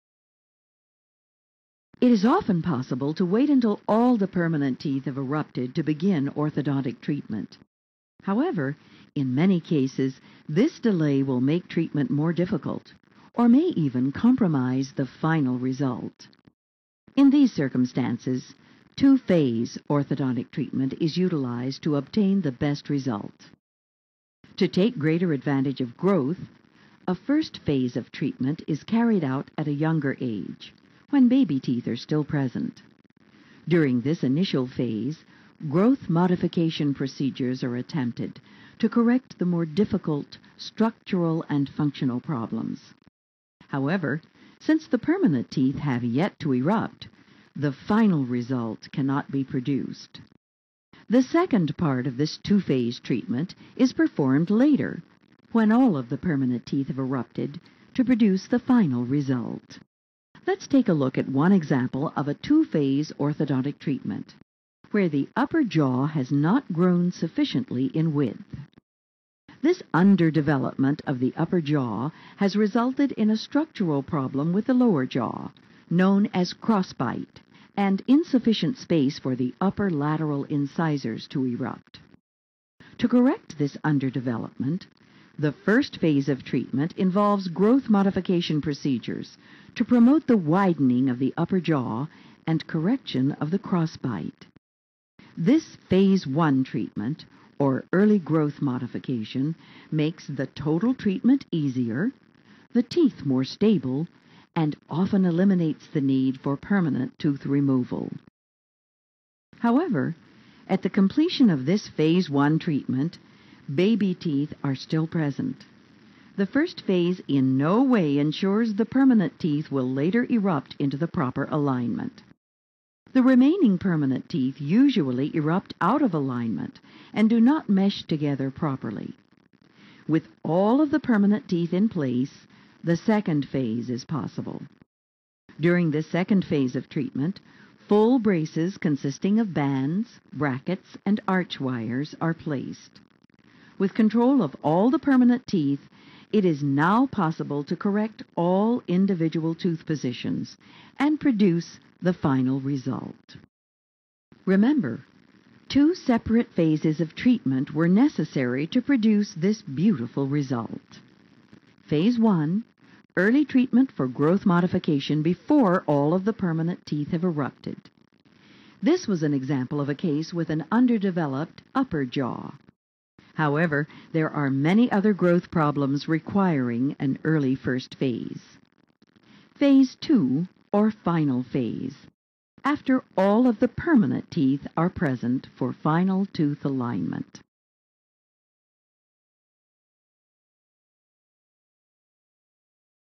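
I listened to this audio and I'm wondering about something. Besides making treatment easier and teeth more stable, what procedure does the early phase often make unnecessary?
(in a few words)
permanent tooth removal.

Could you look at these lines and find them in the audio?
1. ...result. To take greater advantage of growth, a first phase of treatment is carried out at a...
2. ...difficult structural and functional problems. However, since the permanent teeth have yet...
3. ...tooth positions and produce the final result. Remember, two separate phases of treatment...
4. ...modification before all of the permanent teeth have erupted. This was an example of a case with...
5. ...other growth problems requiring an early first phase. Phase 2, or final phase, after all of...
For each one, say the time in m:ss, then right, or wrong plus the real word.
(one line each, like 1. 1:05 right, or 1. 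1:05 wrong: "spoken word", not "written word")
1. 0:22 right
2. 0:39 right
3. 2:29 right
4. 2:44 right
5. 2:54 right.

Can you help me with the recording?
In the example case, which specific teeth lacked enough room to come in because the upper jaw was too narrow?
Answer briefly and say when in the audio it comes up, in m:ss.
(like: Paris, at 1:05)
upper lateral incisors, at 1:19.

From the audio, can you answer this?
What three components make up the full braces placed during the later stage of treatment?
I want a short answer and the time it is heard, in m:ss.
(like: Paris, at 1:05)
bands, brackets, and arch wires, at 2:19.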